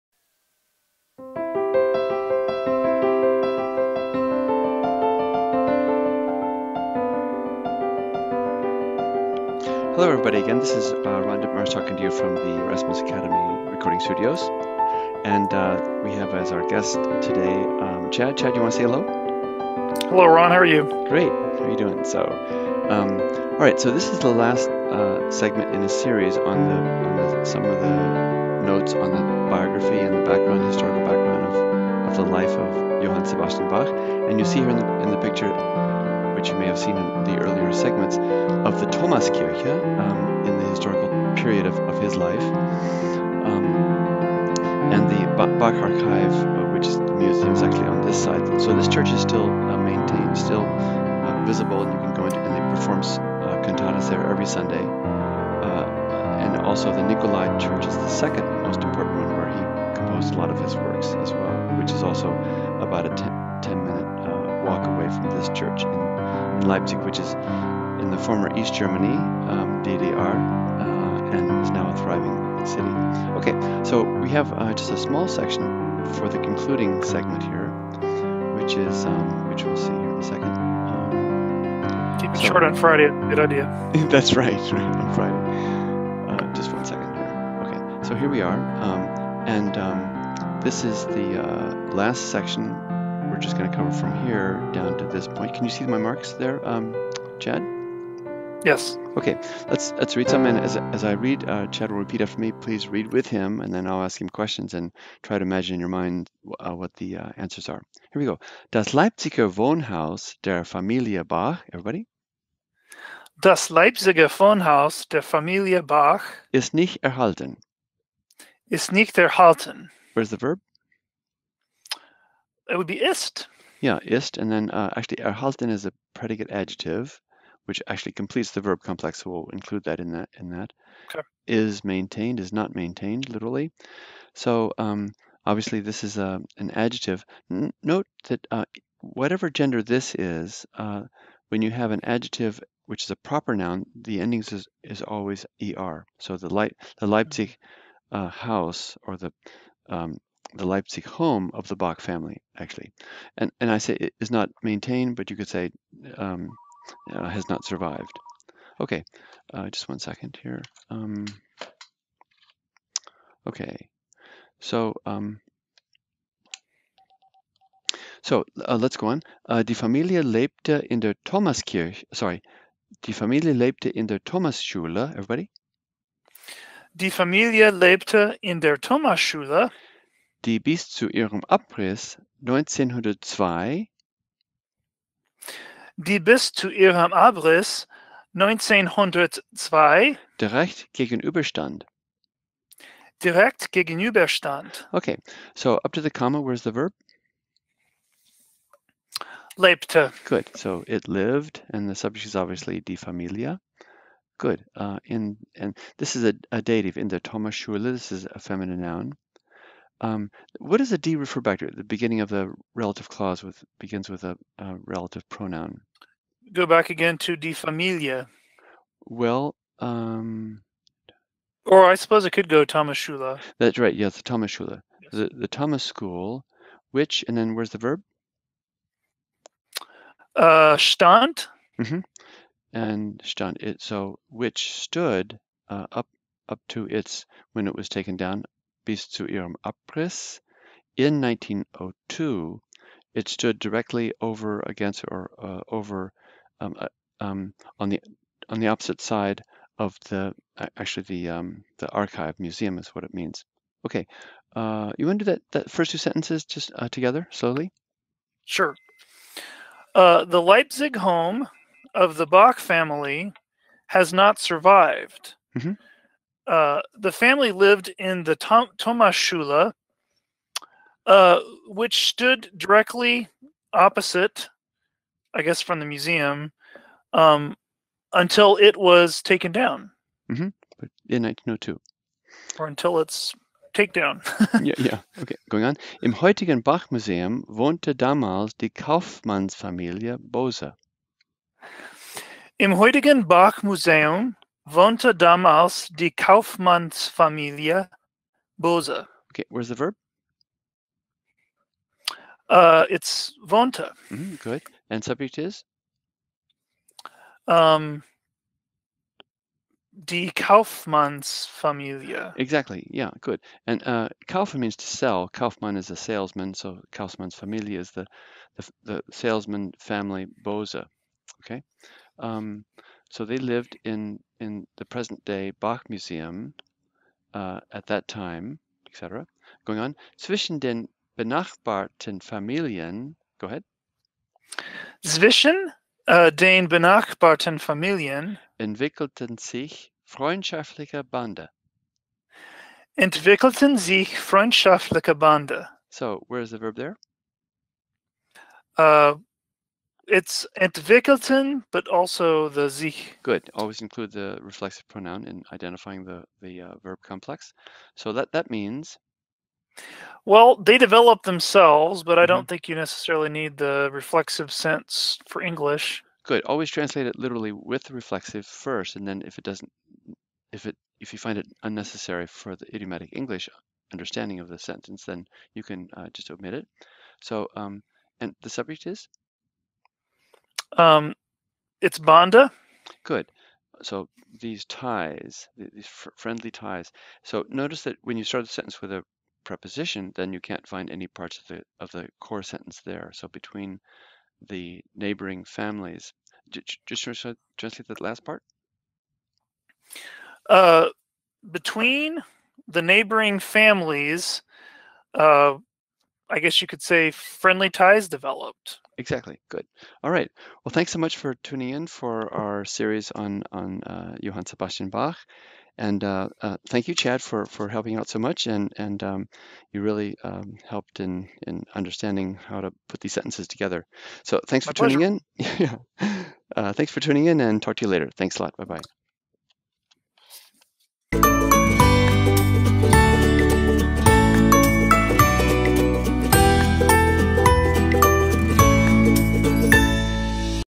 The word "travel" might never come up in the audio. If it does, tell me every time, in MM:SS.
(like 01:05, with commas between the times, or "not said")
not said.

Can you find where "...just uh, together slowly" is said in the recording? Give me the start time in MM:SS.
04:16.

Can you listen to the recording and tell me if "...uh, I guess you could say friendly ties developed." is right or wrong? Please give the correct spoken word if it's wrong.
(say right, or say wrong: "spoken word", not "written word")
right.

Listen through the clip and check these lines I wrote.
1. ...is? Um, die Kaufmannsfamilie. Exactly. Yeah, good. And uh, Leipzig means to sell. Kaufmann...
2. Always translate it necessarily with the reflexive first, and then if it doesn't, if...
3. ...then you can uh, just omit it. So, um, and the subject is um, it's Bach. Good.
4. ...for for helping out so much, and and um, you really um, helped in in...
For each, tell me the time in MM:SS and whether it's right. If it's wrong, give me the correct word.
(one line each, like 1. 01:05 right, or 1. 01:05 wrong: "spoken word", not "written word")
1. 05:05 wrong: "Kaufmann", not "Leipzig"
2. 06:06 wrong: "literally", not "necessarily"
3. 06:15 wrong: "Banda", not "Bach"
4. 06:57 right.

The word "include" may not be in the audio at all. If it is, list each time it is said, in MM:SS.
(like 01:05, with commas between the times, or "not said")
02:09, 05:53.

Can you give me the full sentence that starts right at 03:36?
Go back again to de familia.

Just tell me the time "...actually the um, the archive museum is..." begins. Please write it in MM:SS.
04:10.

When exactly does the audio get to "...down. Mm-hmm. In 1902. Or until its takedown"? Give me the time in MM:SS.
04:39.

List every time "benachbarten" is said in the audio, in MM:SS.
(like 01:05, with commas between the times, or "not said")
05:31, 05:36.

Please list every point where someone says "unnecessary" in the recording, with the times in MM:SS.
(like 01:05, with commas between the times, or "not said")
06:11.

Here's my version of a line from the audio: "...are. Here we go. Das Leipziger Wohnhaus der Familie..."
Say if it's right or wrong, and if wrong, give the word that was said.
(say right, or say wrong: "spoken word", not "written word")
right.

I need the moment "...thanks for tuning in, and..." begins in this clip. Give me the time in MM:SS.
07:06.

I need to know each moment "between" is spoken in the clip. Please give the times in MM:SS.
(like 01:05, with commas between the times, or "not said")
06:33, 06:41.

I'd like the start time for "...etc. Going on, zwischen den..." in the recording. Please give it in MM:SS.
05:28.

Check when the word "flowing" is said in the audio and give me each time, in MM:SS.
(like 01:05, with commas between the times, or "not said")
not said.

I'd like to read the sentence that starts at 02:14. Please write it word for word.
So um, obviously this is a, uh, an adjective.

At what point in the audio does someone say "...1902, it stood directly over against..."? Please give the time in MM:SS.
04:01.